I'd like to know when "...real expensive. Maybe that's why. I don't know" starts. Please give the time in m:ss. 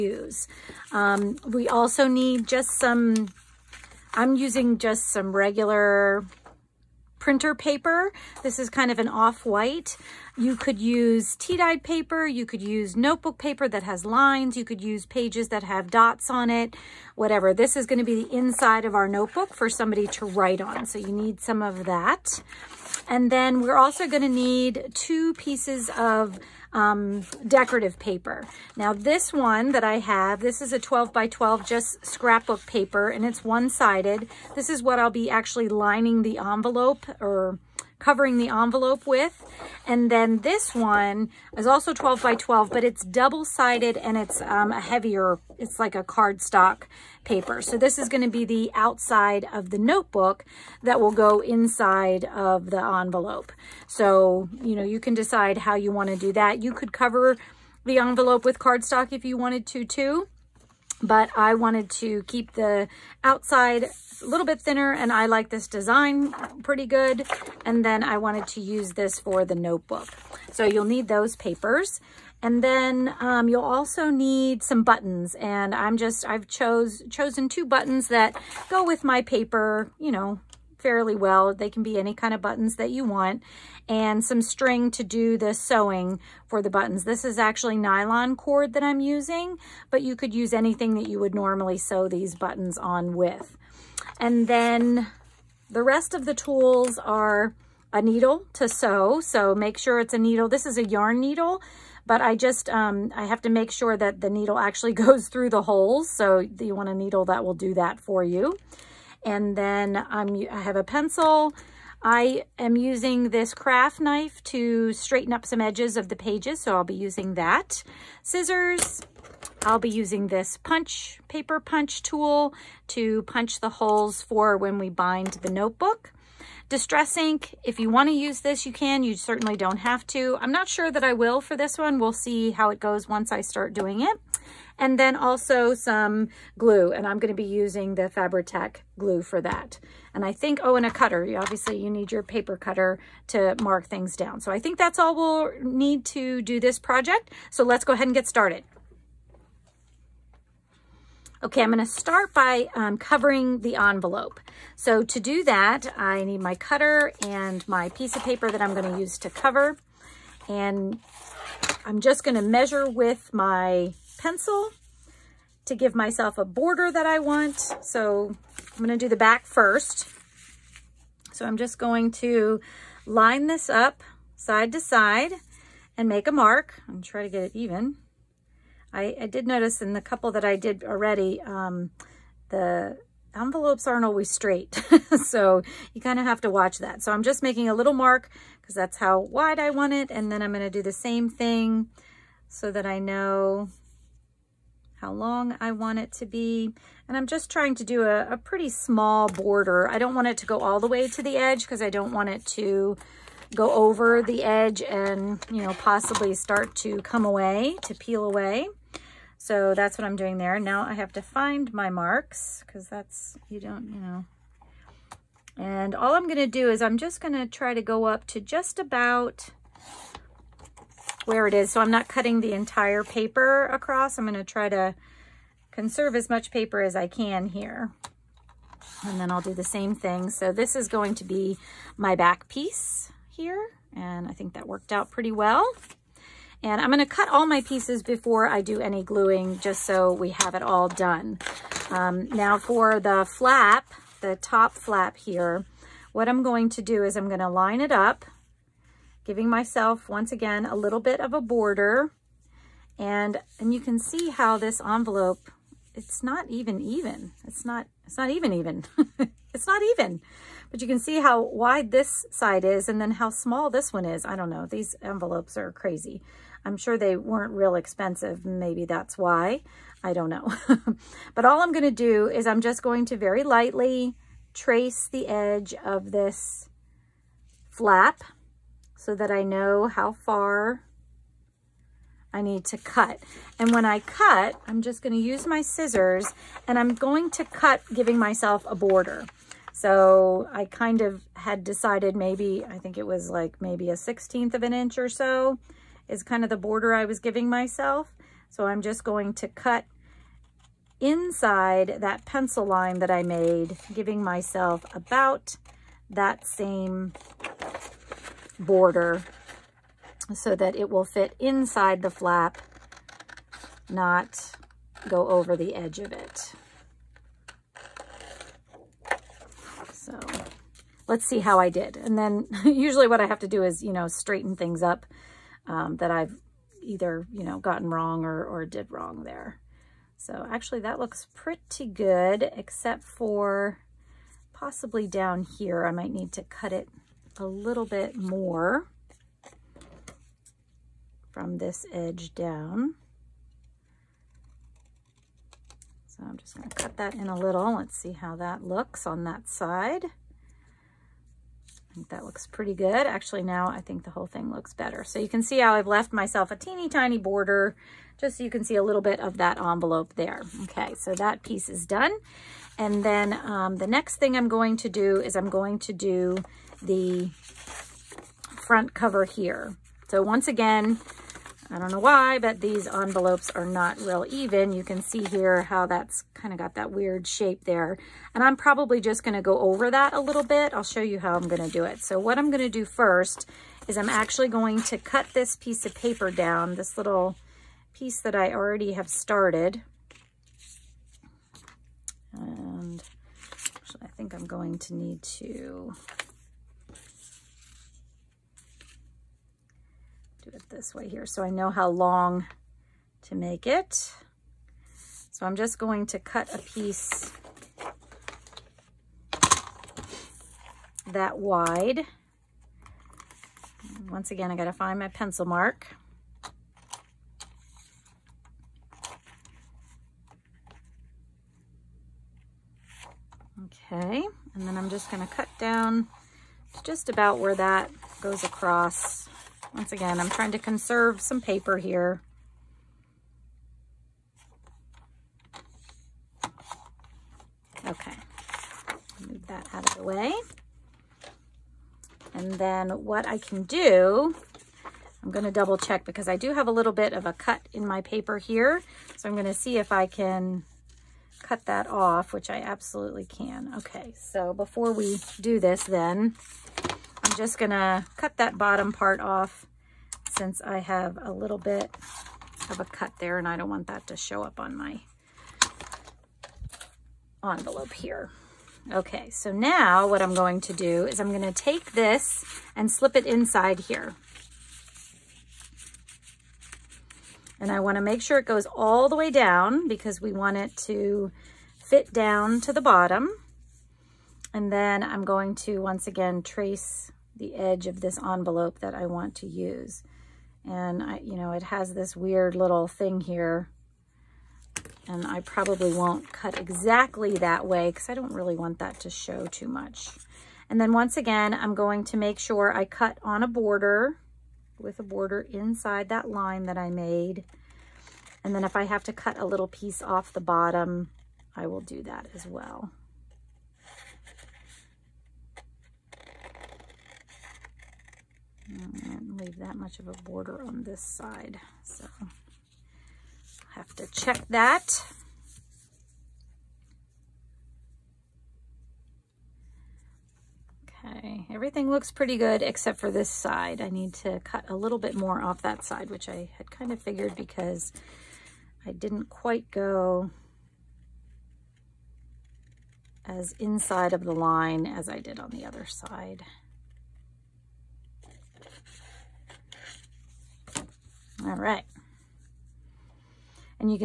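4:27.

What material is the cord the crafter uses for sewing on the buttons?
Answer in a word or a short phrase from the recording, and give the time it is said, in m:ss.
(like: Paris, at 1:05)
Nylon, at 1:27.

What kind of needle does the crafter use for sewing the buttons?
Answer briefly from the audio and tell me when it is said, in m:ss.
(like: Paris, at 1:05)
A yarn needle, at 1:40.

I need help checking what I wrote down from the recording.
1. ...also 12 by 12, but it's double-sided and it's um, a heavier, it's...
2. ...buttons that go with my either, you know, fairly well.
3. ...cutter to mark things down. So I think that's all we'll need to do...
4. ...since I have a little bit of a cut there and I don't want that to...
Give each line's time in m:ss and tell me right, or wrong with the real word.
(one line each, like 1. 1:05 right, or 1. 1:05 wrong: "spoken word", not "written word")
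1. 0:41 right
2. 1:17 wrong: "paper", not "either"
3. 2:22 right
4. 7:40 right.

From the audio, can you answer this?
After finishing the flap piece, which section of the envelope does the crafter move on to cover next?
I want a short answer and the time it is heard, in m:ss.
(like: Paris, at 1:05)
The front cover, at 6:08.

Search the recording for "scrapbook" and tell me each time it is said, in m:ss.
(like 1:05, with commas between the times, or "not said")
0:32.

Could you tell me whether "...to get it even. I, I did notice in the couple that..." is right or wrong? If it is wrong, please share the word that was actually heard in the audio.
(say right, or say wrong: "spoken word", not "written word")
right.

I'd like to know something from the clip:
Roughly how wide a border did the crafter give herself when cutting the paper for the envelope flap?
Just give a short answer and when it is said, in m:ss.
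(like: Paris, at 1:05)
A 16th of an inch, at 4:53.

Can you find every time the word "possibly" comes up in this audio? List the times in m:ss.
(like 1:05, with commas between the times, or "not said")
3:25, 5:34.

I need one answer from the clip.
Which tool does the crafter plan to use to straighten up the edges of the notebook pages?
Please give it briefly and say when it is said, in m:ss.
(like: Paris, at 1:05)
Craft knife, at 1:53.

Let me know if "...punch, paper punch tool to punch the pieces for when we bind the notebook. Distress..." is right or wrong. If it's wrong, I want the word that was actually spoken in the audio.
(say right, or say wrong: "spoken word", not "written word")
wrong: "holes", not "pieces".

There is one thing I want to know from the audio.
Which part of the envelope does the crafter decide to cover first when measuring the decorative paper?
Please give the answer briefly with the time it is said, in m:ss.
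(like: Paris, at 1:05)
The back, at 2:49.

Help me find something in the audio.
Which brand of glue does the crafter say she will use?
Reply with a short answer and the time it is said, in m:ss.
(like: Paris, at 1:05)
Fabri-Tac, at 2:18.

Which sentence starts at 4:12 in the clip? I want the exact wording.
And, and you can see how this envelope, it's not even even.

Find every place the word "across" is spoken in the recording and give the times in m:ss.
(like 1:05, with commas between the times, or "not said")
3:43, 7:08.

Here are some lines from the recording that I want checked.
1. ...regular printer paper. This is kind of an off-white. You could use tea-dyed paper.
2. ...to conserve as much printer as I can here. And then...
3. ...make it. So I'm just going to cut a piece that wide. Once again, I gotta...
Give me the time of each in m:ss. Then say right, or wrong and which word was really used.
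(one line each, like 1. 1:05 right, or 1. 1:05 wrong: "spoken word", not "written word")
1. 0:05 right
2. 3:44 wrong: "paper", not "printer"
3. 6:43 right.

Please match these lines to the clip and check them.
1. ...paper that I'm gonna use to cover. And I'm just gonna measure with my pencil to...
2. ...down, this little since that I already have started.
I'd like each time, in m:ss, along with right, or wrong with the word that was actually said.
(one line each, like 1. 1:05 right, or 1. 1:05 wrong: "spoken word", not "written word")
1. 2:38 right
2. 6:26 wrong: "piece", not "since".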